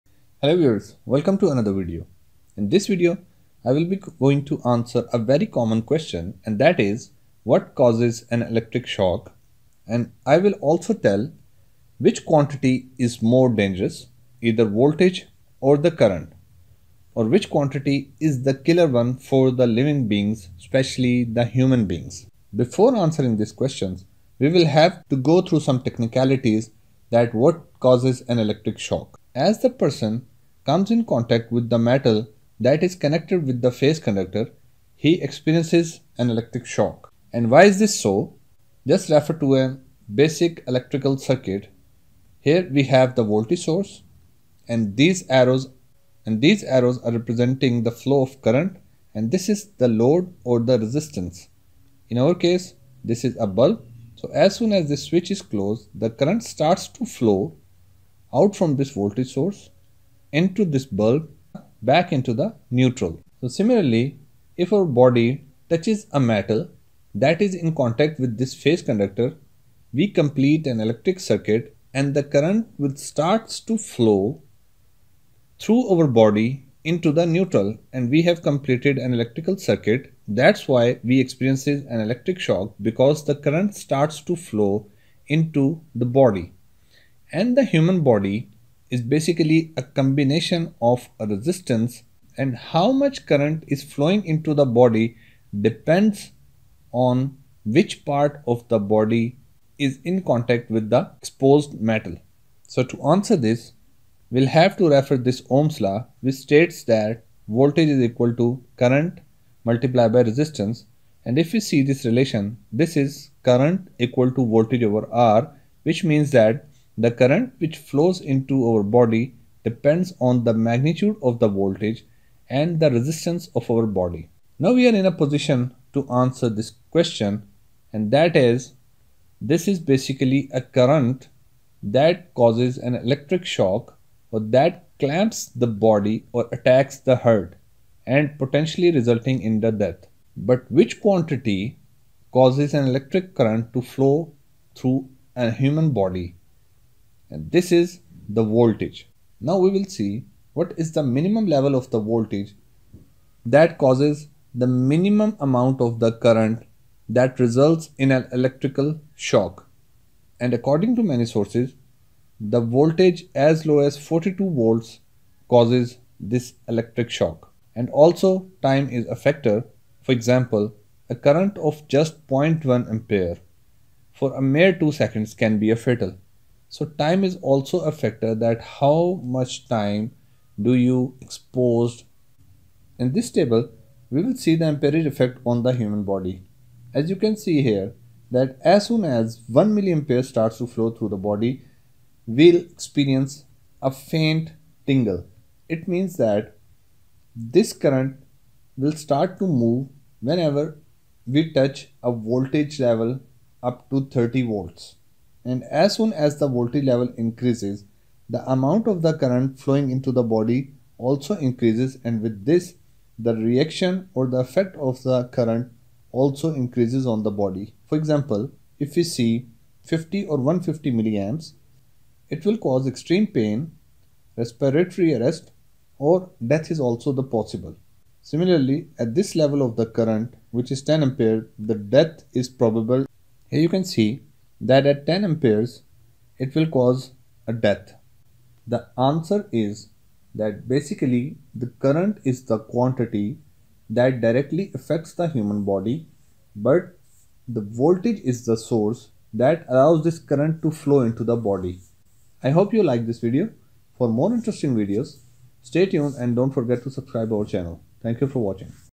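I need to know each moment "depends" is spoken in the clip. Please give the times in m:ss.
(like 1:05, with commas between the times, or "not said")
1:35, 1:59.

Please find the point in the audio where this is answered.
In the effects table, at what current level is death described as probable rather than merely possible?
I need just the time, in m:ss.
3:50.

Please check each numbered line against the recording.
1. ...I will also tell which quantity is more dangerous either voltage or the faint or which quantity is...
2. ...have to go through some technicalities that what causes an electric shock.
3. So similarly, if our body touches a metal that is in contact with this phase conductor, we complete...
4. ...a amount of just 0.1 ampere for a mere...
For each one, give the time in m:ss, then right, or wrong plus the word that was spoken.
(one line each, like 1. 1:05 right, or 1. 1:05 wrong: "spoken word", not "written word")
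1. 0:10 wrong: "current", not "faint"
2. 0:24 right
3. 1:03 right
4. 2:51 wrong: "current", not "amount".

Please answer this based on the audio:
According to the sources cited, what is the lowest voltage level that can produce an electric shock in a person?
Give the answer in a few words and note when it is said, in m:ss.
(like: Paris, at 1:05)
42 volts, at 2:43.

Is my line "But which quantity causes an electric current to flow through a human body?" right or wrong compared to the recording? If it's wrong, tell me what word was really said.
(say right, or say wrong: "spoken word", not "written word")
right.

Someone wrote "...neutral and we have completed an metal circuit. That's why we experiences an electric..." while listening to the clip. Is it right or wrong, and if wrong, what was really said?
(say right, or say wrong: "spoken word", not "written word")
wrong: "electrical", not "metal".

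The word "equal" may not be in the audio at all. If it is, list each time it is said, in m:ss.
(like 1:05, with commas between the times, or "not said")
1:48, 1:53.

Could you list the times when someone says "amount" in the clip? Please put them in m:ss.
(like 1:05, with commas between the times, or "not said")
2:35, 3:28.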